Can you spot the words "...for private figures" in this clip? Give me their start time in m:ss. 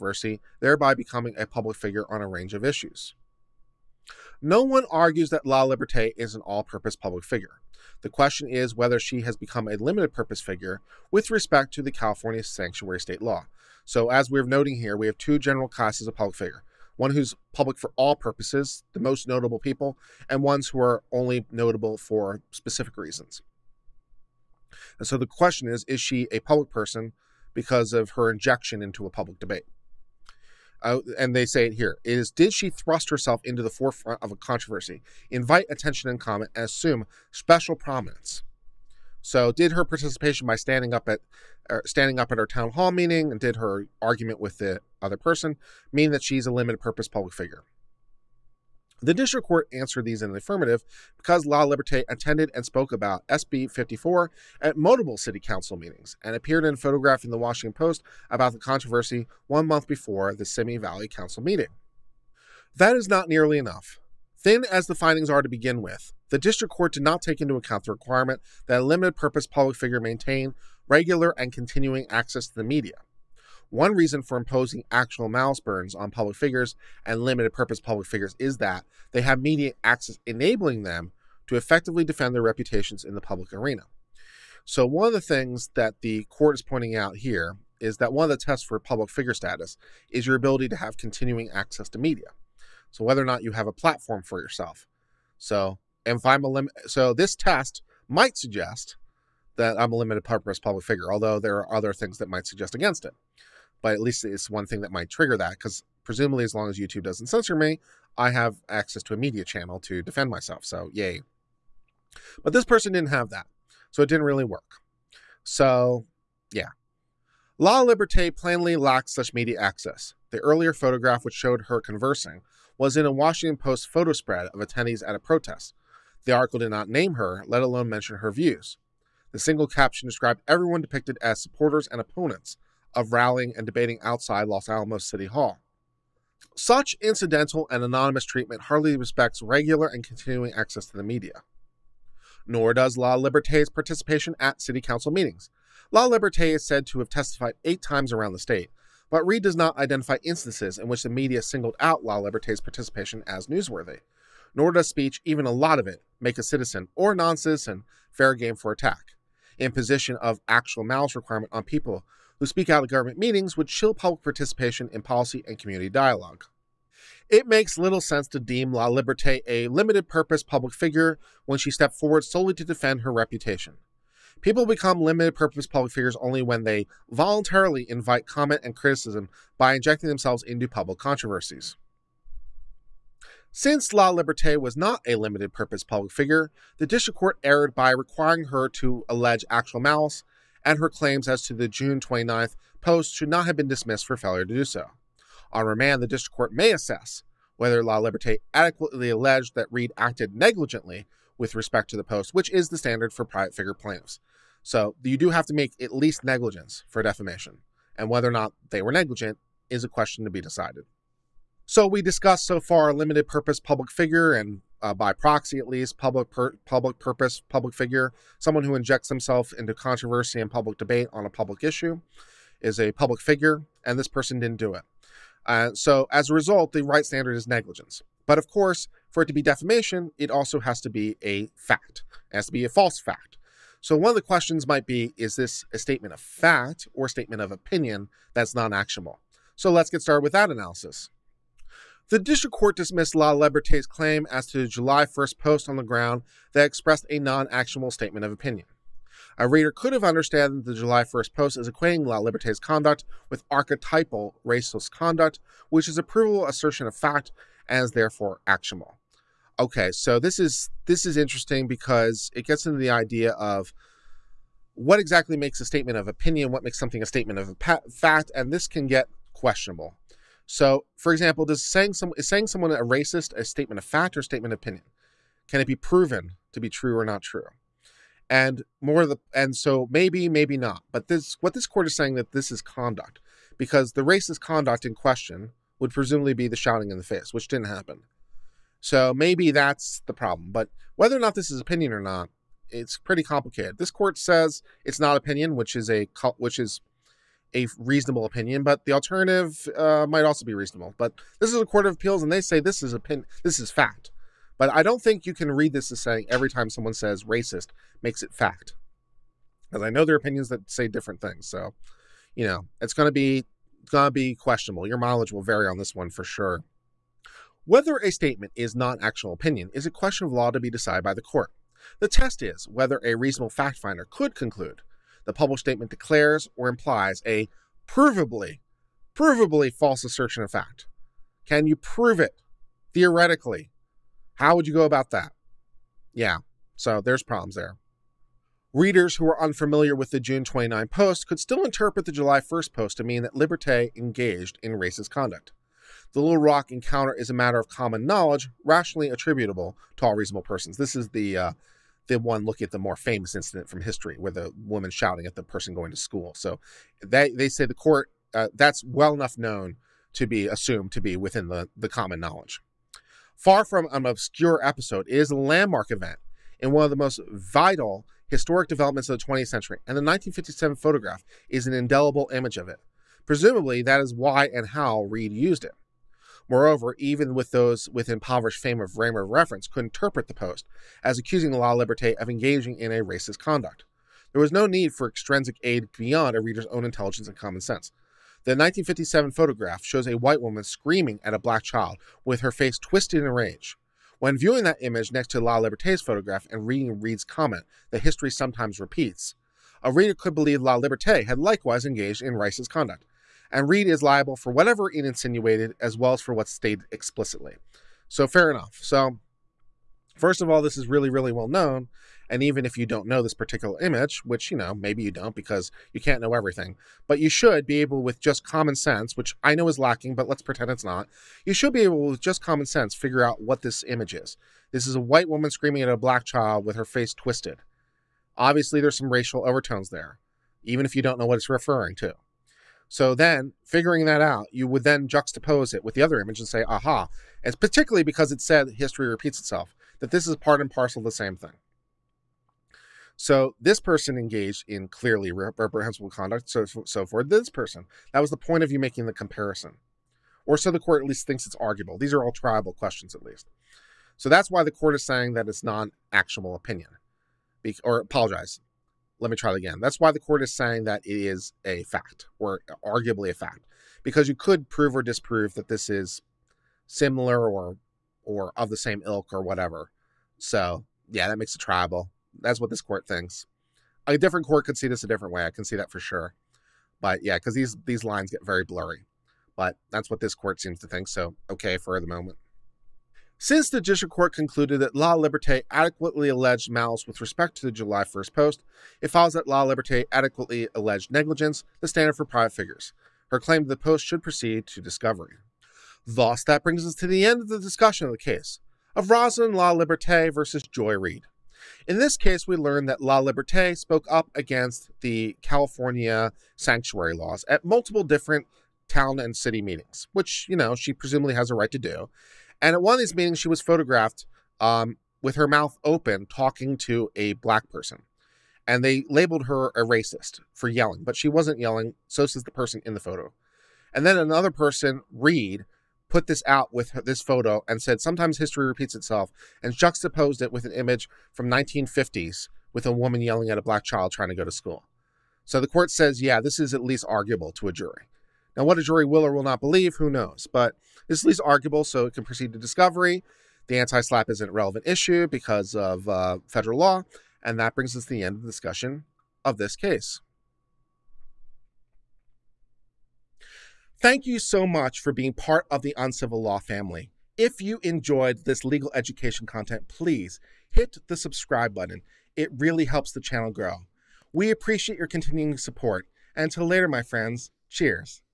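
8:12.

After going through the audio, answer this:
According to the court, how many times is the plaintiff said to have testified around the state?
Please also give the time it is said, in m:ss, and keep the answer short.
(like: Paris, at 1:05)
8, at 2:27.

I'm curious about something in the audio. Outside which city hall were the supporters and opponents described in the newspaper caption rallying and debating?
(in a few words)
Los Alamitos City Hall.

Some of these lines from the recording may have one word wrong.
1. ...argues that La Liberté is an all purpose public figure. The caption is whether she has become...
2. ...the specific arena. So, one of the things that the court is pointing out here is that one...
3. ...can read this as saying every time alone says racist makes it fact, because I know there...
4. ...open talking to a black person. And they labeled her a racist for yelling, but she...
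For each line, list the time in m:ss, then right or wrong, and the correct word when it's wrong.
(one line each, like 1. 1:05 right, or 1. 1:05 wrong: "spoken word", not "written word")
1. 0:04 wrong: "question", not "caption"
2. 1:23 wrong: "public", not "specific"
3. 5:05 wrong: "someone", not "alone"
4. 8:35 right.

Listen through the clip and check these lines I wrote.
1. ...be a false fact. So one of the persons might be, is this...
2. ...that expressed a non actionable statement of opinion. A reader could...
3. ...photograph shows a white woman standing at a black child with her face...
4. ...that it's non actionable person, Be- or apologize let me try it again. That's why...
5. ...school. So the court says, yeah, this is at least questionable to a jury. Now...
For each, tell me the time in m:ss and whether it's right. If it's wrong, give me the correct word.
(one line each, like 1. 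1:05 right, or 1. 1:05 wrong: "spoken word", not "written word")
1. 3:52 wrong: "questions", not "persons"
2. 4:06 right
3. 6:29 wrong: "screaming", not "standing"
4. 7:35 wrong: "opinion", not "person"
5. 8:54 wrong: "arguable", not "questionable".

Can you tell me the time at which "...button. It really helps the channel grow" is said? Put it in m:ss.
9:21.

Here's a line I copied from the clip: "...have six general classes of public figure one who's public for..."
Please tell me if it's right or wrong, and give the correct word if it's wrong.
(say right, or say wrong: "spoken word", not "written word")
wrong: "two", not "six".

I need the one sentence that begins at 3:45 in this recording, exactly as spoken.
Uh, so as a result, the right standard is negligence.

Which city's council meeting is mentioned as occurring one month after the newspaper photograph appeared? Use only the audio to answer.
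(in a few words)
Simi Valley.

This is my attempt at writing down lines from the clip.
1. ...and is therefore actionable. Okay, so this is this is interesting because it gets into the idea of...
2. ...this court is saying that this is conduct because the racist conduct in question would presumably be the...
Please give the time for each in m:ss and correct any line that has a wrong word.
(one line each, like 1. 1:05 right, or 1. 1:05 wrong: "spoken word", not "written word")
1. 4:17 right
2. 4:41 right.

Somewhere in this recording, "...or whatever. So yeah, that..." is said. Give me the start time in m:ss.
7:49.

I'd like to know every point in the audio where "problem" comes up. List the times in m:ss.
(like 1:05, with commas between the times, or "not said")
4:50, 5:37.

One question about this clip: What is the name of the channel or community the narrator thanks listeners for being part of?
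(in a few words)
Uncivil Law.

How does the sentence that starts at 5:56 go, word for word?
So they, they say the court, uh, that's well enough known to be assumed to be within the, the common knowledge.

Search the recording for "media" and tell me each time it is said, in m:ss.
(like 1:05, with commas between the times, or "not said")
1:12, 1:19, 1:31, 1:49, 1:59, 2:21, 2:31.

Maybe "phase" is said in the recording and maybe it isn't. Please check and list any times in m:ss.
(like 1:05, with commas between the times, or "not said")
not said.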